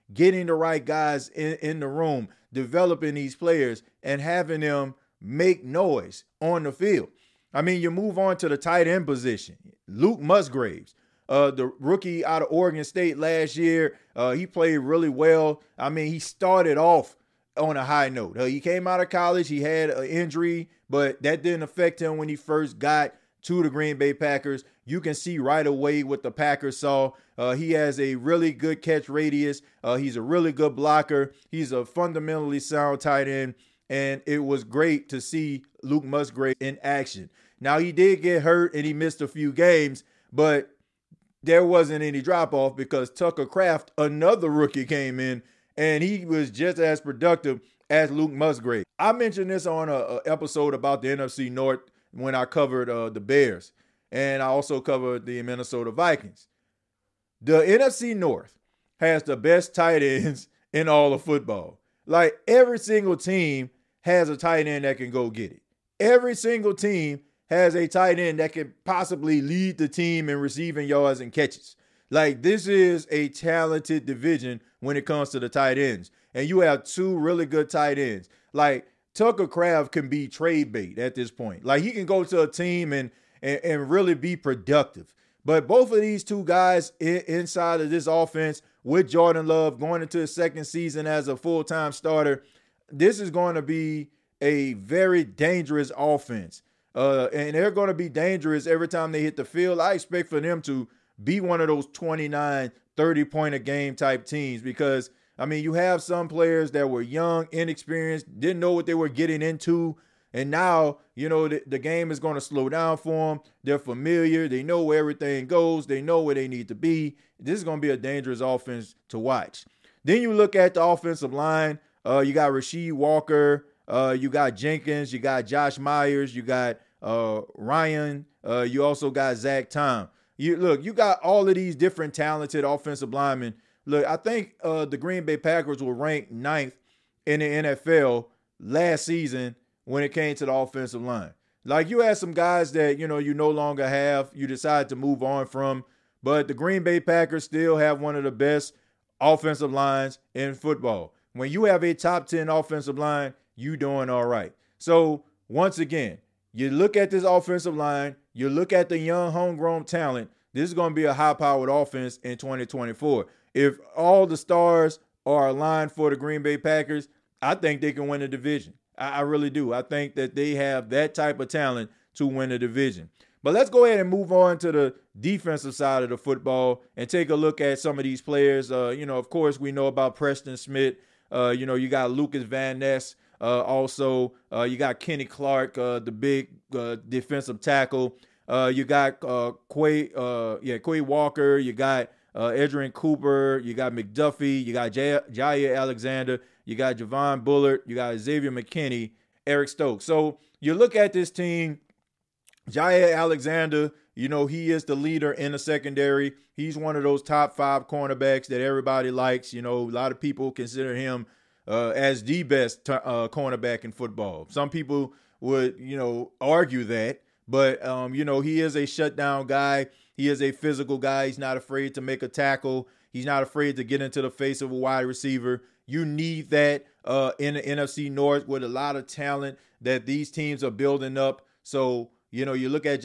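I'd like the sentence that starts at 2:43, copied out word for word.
If all the stars are aligned for the Green Bay Packers, I think they can win the division.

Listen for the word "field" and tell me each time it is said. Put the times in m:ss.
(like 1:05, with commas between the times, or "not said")
0:06, 1:39.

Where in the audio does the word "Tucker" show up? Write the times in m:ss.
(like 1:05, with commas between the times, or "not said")
0:43, 1:19.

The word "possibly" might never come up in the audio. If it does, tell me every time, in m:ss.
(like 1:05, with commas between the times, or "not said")
1:08.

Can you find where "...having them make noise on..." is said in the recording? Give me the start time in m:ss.
0:04.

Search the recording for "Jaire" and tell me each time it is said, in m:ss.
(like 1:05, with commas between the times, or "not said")
3:14, 3:22.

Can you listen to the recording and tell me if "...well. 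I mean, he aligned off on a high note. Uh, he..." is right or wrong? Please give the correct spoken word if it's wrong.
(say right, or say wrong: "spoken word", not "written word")
wrong: "started", not "aligned".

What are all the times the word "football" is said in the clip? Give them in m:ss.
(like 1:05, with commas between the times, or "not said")
1:01, 2:30, 2:56, 3:33.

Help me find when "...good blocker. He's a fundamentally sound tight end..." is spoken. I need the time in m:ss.
0:30.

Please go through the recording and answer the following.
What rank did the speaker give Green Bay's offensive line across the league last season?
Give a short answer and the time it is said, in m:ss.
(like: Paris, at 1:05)
9th, at 2:16.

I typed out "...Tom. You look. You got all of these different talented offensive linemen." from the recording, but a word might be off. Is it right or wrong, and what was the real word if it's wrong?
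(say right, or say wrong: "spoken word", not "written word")
right.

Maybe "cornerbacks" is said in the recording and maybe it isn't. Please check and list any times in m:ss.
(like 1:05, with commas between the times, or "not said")
3:27, 3:33.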